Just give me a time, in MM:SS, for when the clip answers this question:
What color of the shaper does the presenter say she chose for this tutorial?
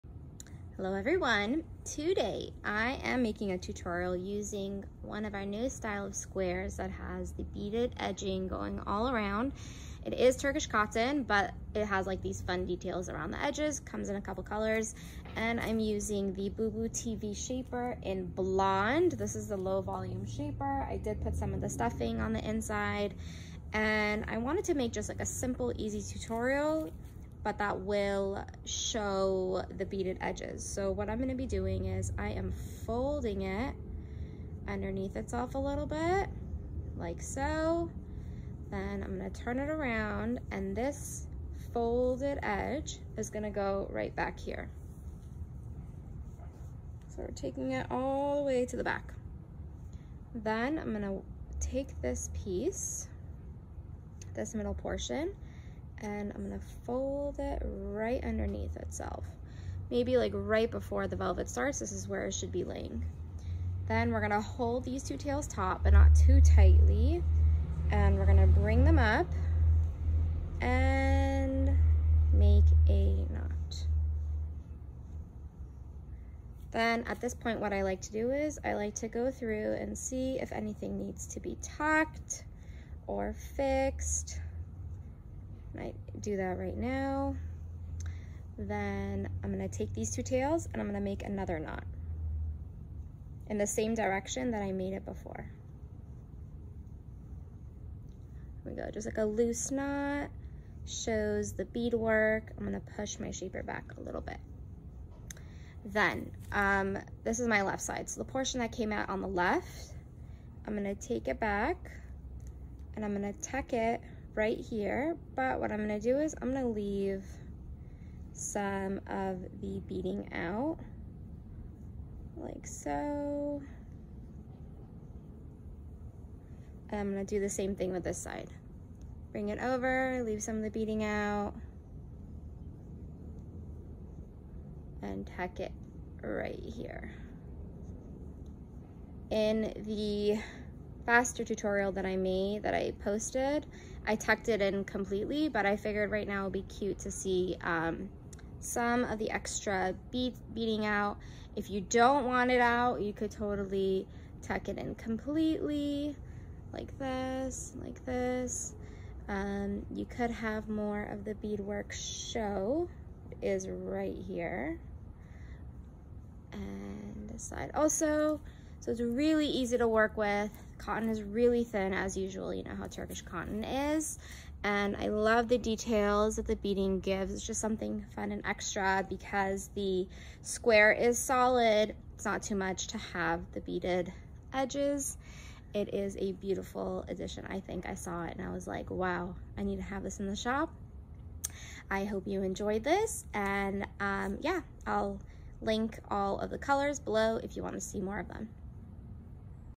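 00:18.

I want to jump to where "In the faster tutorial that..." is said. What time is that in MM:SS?
02:19.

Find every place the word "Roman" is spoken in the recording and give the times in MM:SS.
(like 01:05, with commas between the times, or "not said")
not said.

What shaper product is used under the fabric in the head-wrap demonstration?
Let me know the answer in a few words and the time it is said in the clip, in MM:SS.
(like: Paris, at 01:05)
Boubou Tivi Shaper, at 00:16.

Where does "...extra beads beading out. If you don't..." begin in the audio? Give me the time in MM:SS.
02:29.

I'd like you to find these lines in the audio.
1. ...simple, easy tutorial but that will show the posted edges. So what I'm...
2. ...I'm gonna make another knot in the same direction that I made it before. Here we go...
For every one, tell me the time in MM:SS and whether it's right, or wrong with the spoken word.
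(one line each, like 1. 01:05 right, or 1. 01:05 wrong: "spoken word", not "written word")
1. 00:25 wrong: "beaded", not "posted"
2. 01:30 right.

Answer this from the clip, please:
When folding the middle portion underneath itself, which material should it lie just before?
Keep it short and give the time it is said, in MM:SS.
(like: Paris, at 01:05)
velvet, at 01:01.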